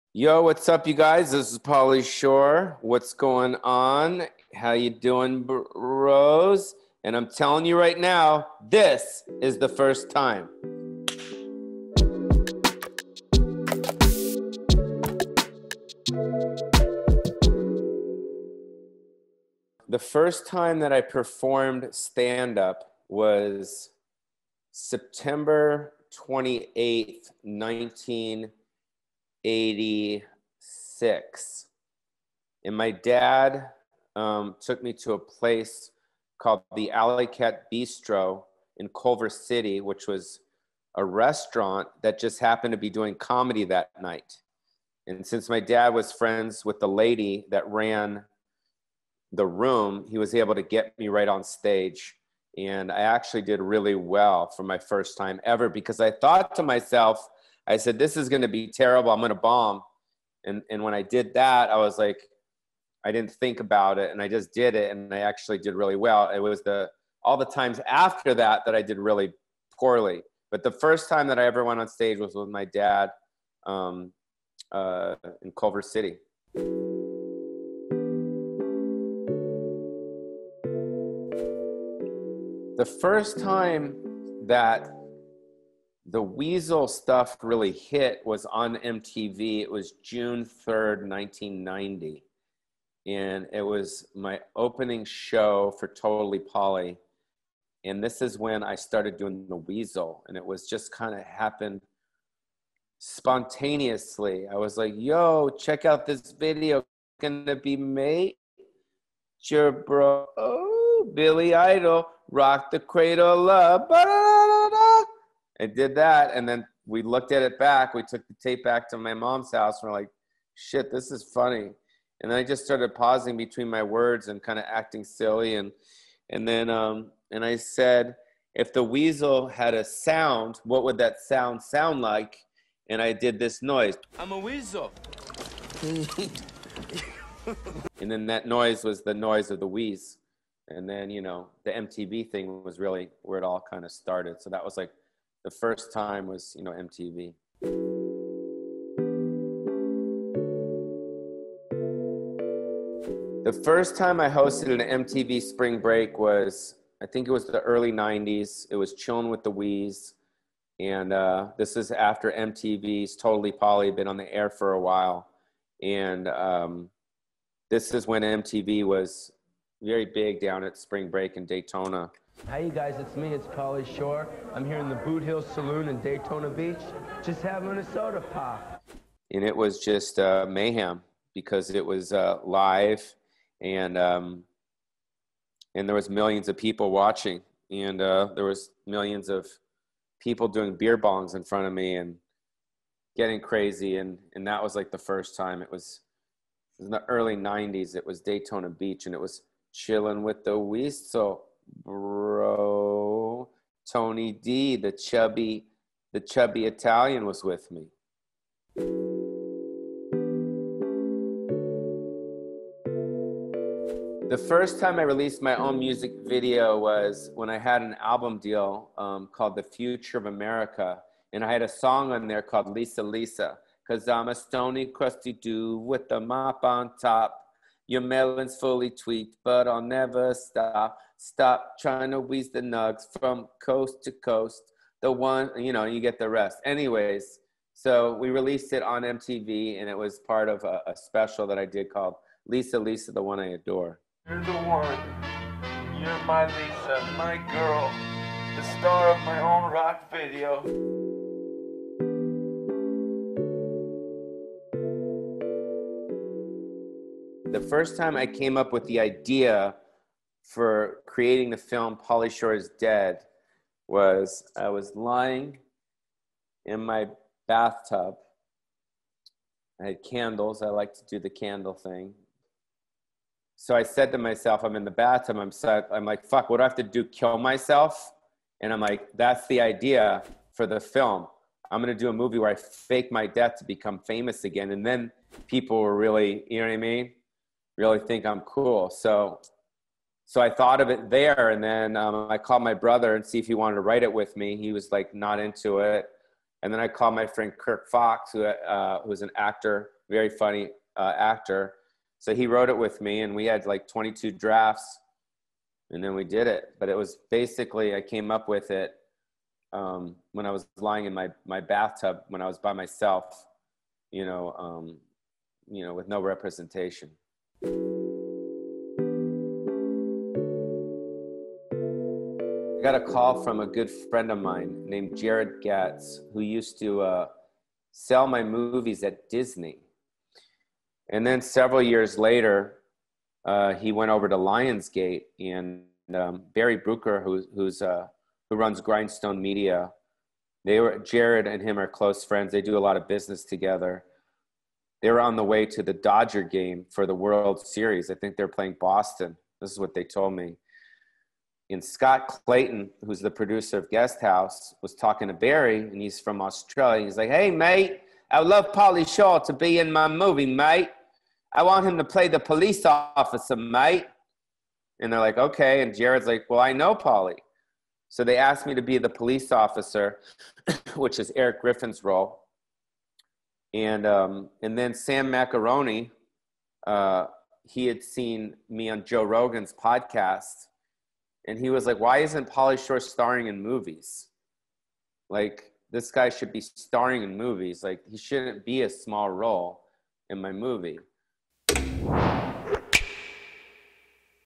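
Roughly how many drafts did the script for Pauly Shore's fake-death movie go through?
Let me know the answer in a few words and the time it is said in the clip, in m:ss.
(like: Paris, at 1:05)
22, at 5:03.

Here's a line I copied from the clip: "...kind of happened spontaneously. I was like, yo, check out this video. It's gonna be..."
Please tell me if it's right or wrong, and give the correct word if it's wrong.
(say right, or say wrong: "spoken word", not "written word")
right.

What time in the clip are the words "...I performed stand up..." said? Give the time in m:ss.
0:20.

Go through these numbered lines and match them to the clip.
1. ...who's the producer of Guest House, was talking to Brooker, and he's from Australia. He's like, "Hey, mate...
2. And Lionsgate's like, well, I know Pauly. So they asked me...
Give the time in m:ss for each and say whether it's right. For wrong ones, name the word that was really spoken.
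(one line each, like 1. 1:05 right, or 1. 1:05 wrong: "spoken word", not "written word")
1. 5:53 wrong: "Barry", not "Brooker"
2. 6:05 wrong: "Jared", not "Lionsgate".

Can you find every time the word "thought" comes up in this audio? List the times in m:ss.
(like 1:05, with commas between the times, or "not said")
0:56, 4:50.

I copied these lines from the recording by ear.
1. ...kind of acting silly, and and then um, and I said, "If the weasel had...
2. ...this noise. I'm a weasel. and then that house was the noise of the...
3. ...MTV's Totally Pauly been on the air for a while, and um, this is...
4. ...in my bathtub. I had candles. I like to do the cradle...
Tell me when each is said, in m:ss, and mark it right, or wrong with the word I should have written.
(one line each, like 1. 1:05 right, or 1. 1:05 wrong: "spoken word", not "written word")
1. 2:04 right
2. 2:13 wrong: "noise", not "house"
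3. 2:42 right
4. 4:26 wrong: "candle", not "cradle".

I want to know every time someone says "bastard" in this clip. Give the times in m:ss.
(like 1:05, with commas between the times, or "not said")
not said.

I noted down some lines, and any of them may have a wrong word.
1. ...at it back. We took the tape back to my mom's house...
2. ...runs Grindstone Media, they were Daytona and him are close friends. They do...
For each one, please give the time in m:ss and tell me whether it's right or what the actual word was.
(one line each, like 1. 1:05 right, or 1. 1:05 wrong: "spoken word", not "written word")
1. 1:57 right
2. 5:38 wrong: "Jared", not "Daytona".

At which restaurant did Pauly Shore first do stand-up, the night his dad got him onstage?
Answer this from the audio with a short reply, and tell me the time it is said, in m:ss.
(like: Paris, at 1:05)
Alley Cat Bistro, at 0:36.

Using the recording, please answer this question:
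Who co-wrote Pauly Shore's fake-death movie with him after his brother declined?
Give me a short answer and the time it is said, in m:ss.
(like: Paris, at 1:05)
Kirk Fox, at 4:57.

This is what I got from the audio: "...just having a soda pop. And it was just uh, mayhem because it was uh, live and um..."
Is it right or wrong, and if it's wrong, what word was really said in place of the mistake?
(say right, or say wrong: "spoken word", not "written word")
right.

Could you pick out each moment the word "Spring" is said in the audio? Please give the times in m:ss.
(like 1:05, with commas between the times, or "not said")
2:35, 2:50.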